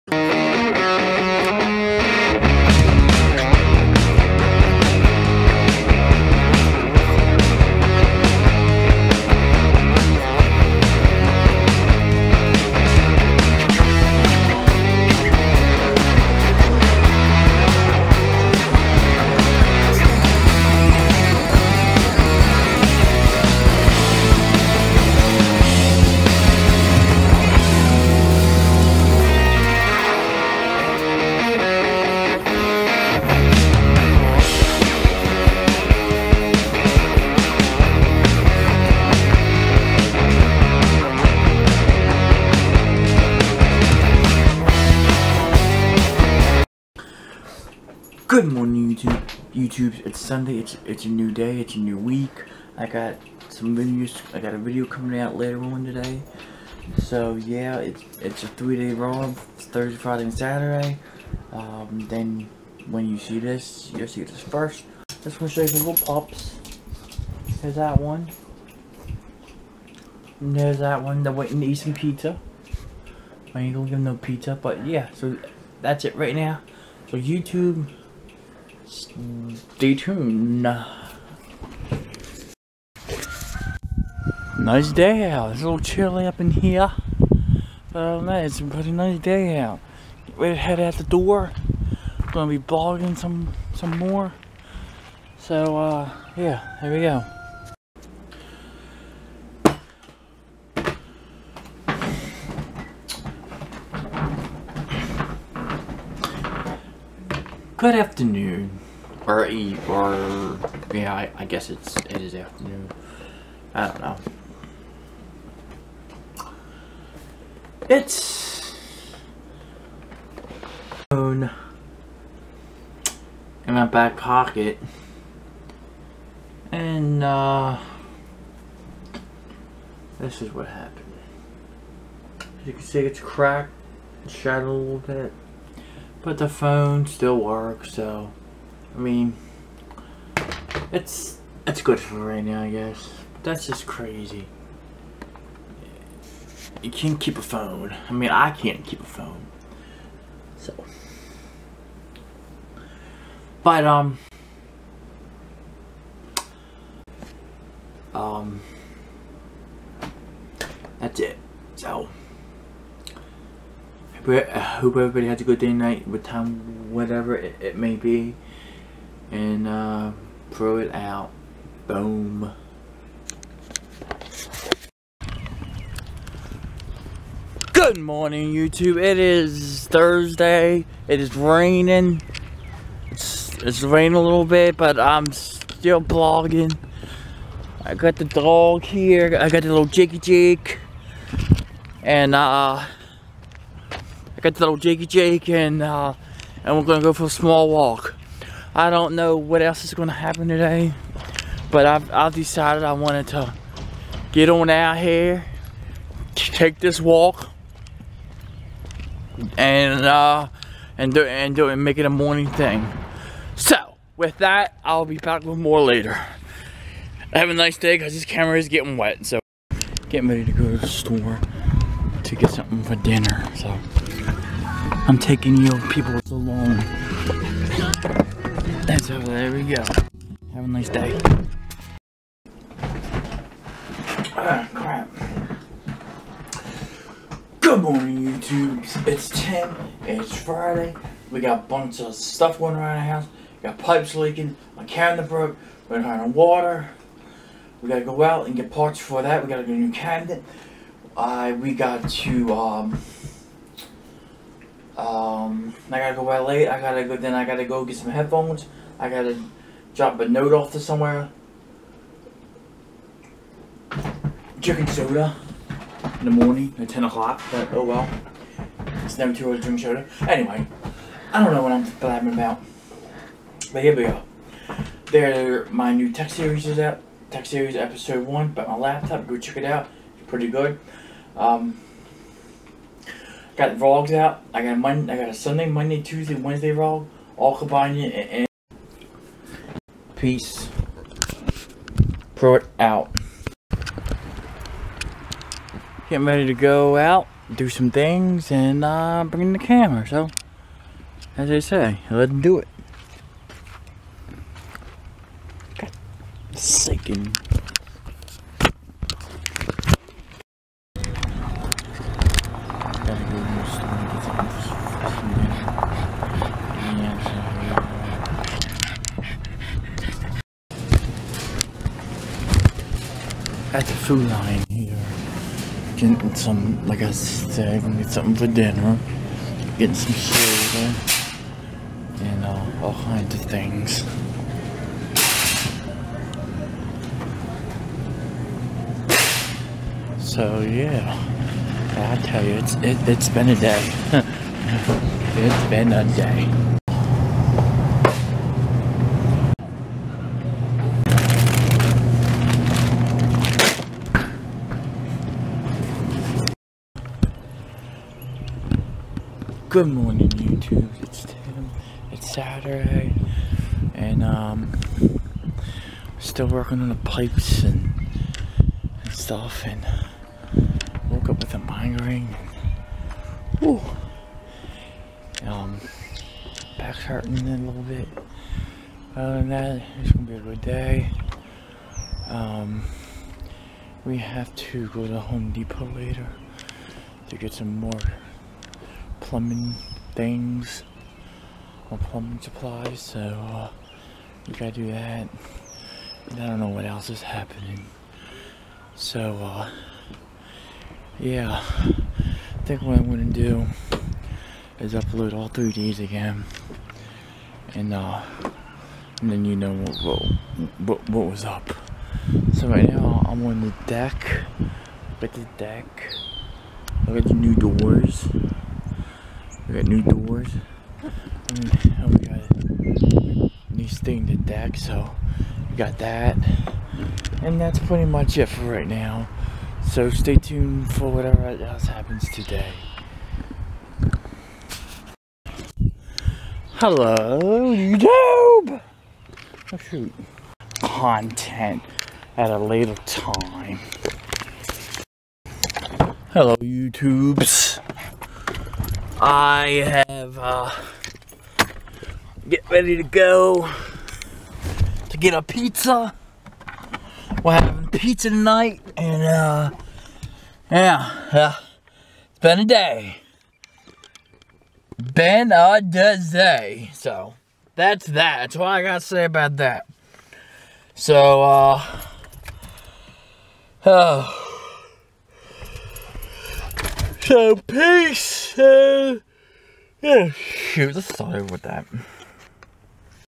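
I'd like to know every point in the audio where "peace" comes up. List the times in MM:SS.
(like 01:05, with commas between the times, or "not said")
04:50, 07:57.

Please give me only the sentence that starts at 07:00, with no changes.
Mm, and, we got new thing to deck, so we got that.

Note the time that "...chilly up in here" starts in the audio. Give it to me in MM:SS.
01:25.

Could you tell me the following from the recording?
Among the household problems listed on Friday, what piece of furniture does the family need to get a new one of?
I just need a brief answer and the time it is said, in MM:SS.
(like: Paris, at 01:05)
cabinet, at 04:09.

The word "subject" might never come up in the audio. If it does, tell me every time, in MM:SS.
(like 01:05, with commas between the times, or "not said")
not said.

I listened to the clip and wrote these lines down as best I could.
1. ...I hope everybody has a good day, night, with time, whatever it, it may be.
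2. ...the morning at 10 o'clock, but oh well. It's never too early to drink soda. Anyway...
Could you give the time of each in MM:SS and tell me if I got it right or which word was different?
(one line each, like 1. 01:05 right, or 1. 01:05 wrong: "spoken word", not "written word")
1. 02:44 right
2. 04:26 right.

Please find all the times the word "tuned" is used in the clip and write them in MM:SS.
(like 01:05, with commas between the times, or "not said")
01:19, 07:10.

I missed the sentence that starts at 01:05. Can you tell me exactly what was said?
Just going to show you the little pops.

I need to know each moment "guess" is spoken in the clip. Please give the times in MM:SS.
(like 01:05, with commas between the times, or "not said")
01:51, 02:22.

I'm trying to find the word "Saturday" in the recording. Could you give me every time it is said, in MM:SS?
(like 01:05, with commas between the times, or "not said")
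01:00, 06:02.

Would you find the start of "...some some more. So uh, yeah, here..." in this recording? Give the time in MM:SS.
01:33.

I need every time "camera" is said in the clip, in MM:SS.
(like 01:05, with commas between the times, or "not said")
03:38, 04:59.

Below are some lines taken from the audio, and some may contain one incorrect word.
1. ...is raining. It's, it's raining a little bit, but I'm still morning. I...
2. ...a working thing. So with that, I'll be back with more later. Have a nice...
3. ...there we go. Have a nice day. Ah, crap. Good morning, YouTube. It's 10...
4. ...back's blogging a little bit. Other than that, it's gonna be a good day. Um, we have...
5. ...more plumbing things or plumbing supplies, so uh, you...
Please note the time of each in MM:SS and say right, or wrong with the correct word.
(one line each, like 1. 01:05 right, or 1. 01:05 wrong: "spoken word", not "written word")
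1. 03:01 wrong: "blogging", not "morning"
2. 03:32 wrong: "morning", not "working"
3. 03:49 right
4. 06:16 wrong: "hurting", not "blogging"
5. 06:27 right.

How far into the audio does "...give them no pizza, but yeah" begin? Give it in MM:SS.
01:13.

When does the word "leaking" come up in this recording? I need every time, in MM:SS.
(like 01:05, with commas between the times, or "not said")
04:04.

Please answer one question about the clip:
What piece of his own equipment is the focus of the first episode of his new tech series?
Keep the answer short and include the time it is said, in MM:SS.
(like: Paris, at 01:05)
laptop, at 04:38.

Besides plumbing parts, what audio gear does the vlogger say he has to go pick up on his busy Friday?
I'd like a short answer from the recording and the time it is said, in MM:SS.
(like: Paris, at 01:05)
headphones, at 04:18.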